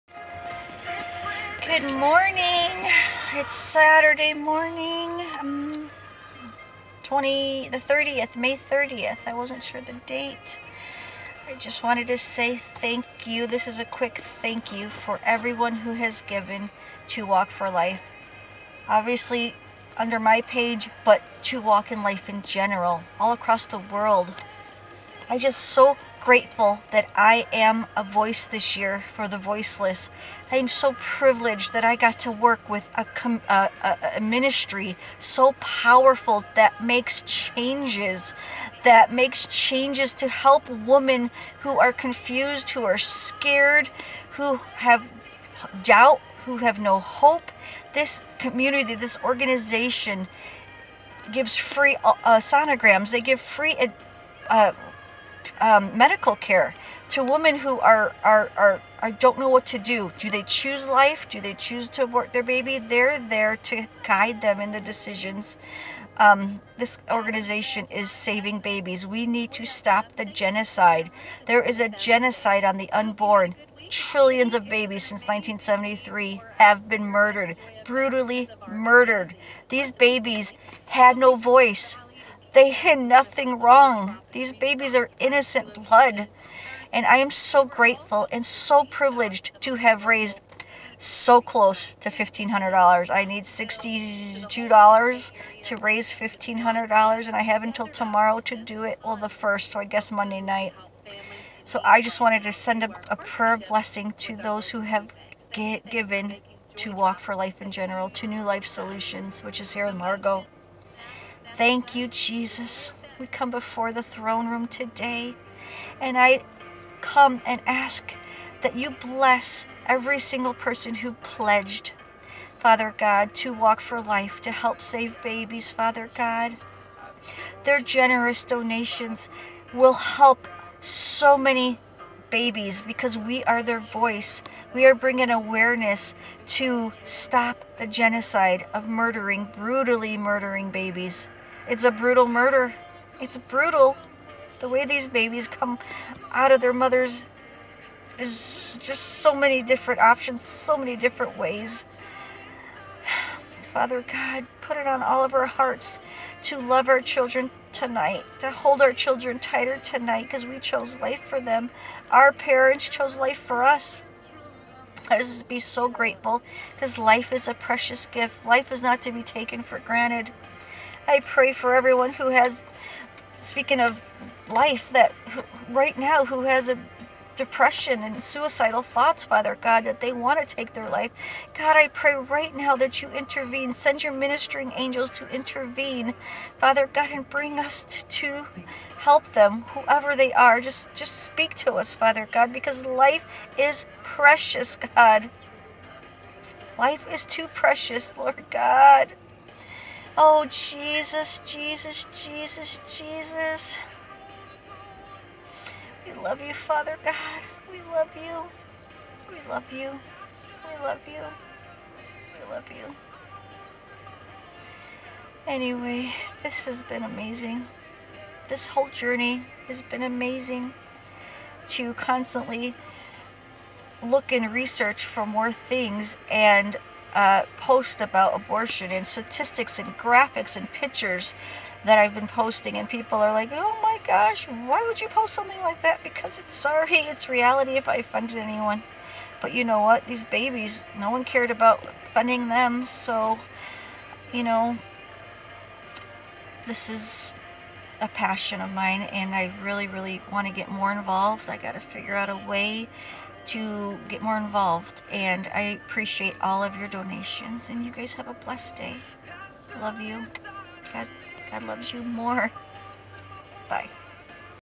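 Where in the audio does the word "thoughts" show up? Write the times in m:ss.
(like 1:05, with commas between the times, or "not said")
2:58.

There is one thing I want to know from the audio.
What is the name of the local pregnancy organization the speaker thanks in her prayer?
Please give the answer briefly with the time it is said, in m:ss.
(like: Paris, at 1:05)
New Life Solutions, at 1:48.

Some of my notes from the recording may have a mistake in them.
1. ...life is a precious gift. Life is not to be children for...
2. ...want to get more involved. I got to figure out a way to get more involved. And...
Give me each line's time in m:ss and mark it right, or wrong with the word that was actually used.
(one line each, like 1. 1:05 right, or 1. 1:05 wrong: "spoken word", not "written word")
1. 2:46 wrong: "taken", not "children"
2. 4:10 right.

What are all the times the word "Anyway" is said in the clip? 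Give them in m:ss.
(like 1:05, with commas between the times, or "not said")
3:35.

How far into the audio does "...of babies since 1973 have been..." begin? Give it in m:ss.
1:14.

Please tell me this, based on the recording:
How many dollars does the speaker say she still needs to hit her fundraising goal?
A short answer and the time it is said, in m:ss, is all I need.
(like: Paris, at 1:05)
$62, at 1:33.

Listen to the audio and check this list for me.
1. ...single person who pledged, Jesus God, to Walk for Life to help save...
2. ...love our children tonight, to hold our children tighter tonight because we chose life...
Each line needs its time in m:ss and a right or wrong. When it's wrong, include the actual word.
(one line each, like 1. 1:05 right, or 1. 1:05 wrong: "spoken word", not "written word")
1. 2:00 wrong: "Father", not "Jesus"
2. 2:36 right.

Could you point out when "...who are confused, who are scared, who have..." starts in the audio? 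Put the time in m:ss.
0:41.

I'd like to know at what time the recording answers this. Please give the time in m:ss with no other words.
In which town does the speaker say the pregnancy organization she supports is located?
1:49.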